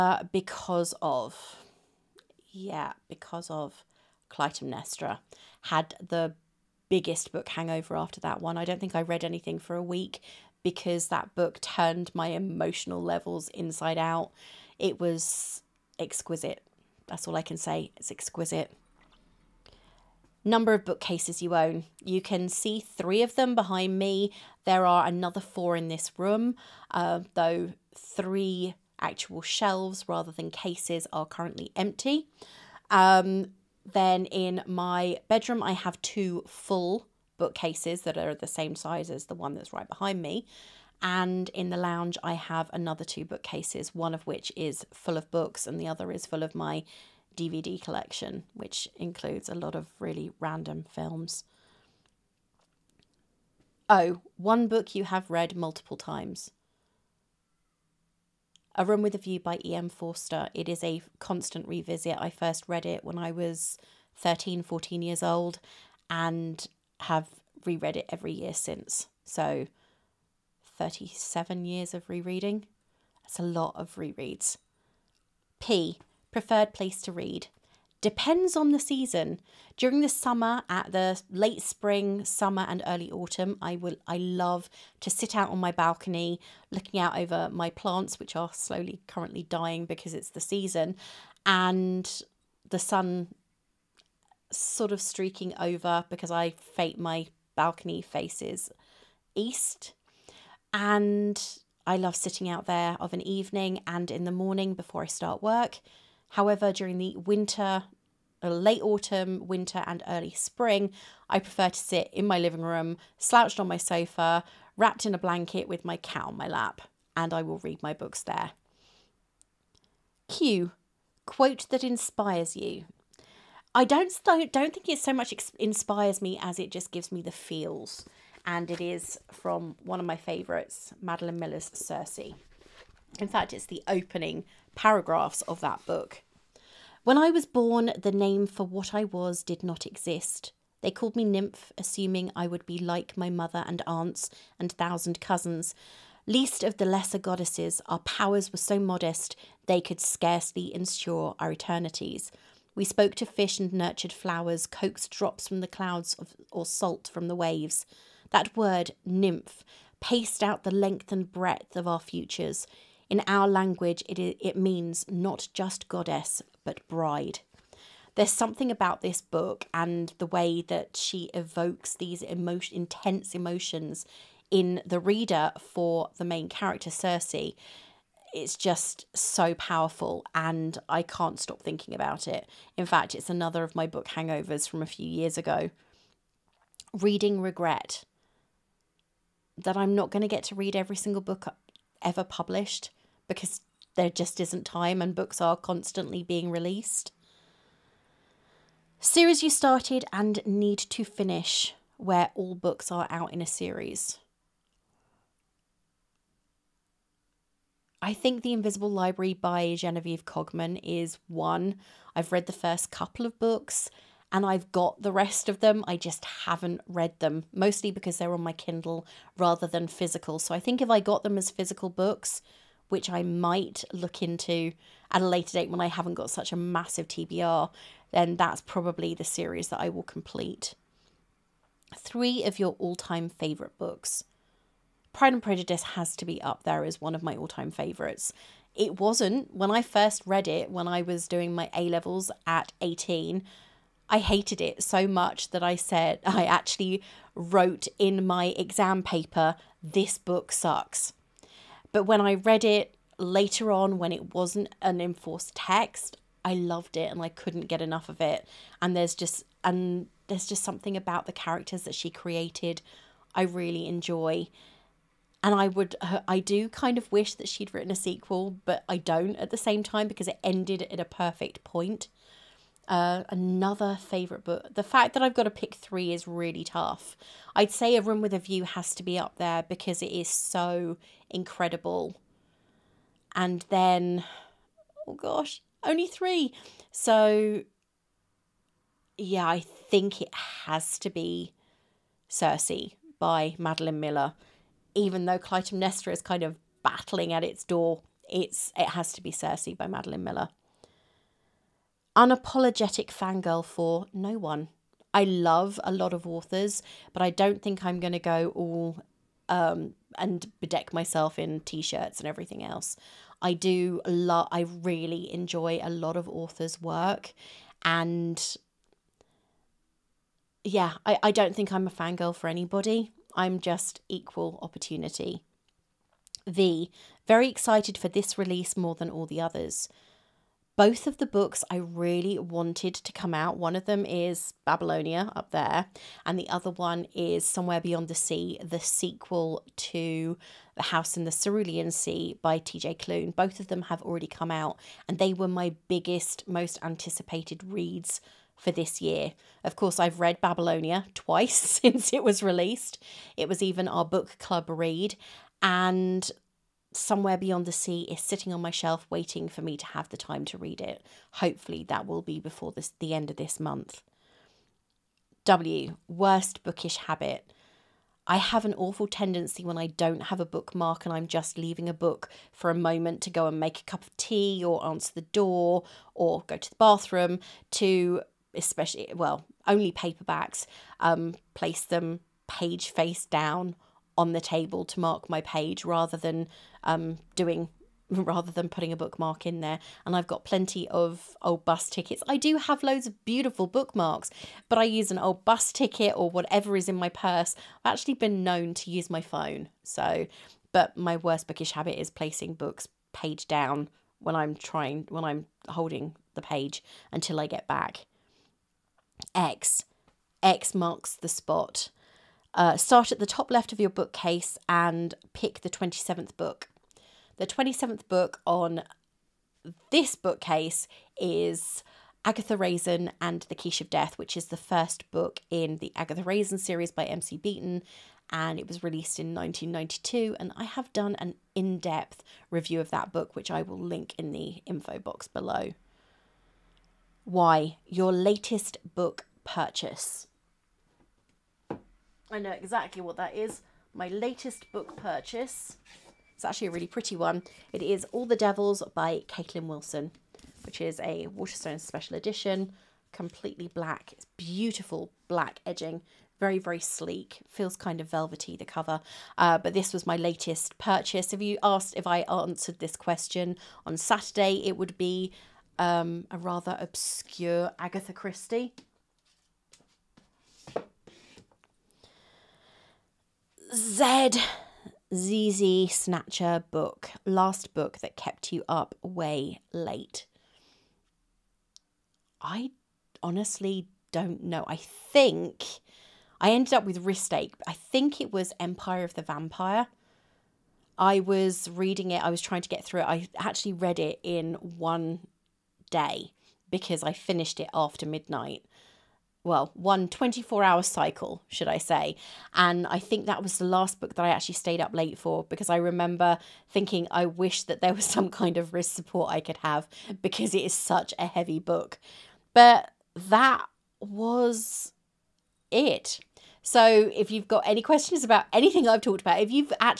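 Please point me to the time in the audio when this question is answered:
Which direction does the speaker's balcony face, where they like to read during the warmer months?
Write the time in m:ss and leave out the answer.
1:38.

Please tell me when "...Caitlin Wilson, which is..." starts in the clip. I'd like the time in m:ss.
7:29.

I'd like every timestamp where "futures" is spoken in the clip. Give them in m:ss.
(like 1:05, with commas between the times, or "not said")
2:42.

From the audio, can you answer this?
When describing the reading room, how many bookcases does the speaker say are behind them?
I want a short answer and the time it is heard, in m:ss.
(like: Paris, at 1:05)
3, at 0:22.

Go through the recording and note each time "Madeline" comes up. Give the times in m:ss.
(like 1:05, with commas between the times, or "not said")
2:11, 4:53, 4:59.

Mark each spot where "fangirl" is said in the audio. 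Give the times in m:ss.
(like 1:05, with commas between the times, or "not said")
5:03, 5:21.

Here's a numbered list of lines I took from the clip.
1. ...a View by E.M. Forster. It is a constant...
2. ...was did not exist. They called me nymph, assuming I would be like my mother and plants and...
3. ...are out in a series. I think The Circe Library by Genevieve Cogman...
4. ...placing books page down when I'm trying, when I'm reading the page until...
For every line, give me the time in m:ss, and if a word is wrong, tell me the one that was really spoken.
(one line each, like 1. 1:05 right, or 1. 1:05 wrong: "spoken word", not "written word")
1. 0:59 right
2. 2:19 wrong: "aunts", not "plants"
3. 3:22 wrong: "Invisible", not "Circe"
4. 6:42 wrong: "holding", not "reading".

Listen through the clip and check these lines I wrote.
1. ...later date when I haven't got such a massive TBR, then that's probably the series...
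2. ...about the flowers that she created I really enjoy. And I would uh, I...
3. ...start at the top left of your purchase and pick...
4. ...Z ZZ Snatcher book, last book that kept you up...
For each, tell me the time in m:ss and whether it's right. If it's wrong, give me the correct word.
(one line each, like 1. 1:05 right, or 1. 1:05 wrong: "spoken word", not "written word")
1. 3:45 right
2. 4:20 wrong: "characters", not "flowers"
3. 6:52 wrong: "bookcase", not "purchase"
4. 7:53 right.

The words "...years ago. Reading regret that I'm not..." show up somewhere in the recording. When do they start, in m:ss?
3:05.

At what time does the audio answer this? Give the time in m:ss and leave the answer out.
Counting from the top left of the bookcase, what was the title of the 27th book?
7:02.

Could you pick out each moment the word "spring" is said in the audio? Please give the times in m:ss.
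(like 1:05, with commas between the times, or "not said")
1:21, 1:50.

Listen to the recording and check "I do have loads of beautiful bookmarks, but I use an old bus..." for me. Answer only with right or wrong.
right.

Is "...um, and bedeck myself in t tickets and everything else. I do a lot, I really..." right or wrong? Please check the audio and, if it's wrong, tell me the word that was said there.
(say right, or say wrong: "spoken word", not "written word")
wrong: "shirts", not "tickets".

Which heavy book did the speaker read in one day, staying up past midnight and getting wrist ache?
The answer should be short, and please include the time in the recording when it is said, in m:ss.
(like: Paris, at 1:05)
Empire of the Vampire, at 8:08.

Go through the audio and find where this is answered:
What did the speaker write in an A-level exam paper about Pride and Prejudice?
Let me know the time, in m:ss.
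4:09.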